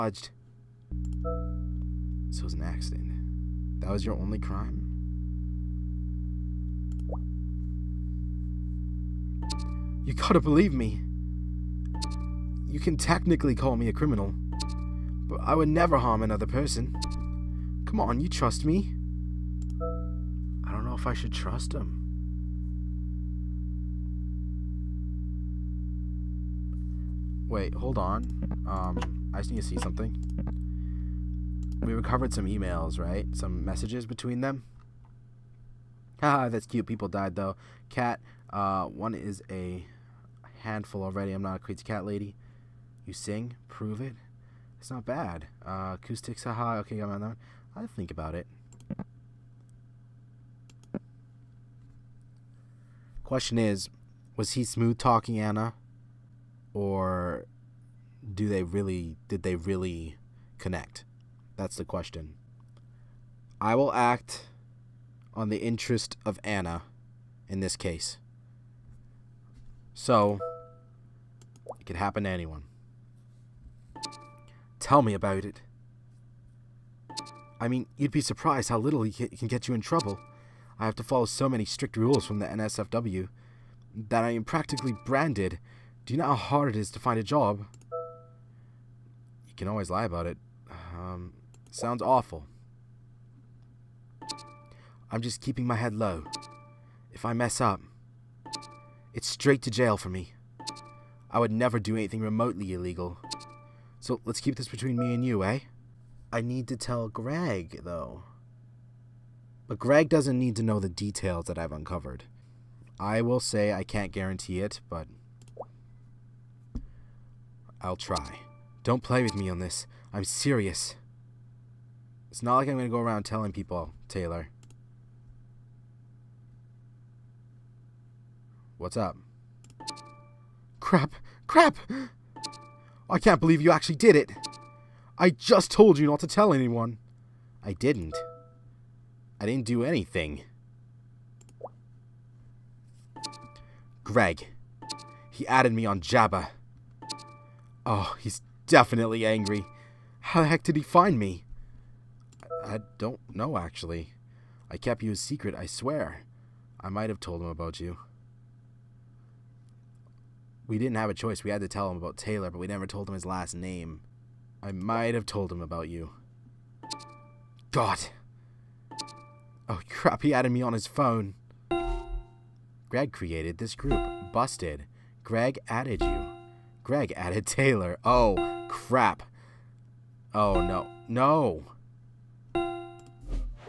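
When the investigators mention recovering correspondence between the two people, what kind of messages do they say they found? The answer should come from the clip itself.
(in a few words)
emails.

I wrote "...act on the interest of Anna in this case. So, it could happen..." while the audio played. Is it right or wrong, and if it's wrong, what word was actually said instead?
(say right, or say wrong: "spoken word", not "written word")
right.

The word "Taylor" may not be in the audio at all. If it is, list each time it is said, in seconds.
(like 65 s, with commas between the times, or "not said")
124 s, 162 s, 177 s.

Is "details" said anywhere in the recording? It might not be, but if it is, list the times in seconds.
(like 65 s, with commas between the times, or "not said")
110 s.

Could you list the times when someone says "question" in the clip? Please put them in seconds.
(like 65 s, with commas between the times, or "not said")
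53 s, 61 s.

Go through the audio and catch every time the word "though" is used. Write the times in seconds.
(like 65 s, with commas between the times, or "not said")
37 s, 107 s.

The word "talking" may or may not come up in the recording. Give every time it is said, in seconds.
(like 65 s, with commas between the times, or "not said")
54 s.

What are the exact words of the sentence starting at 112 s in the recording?
I will say I can't guarantee it, but I'll try.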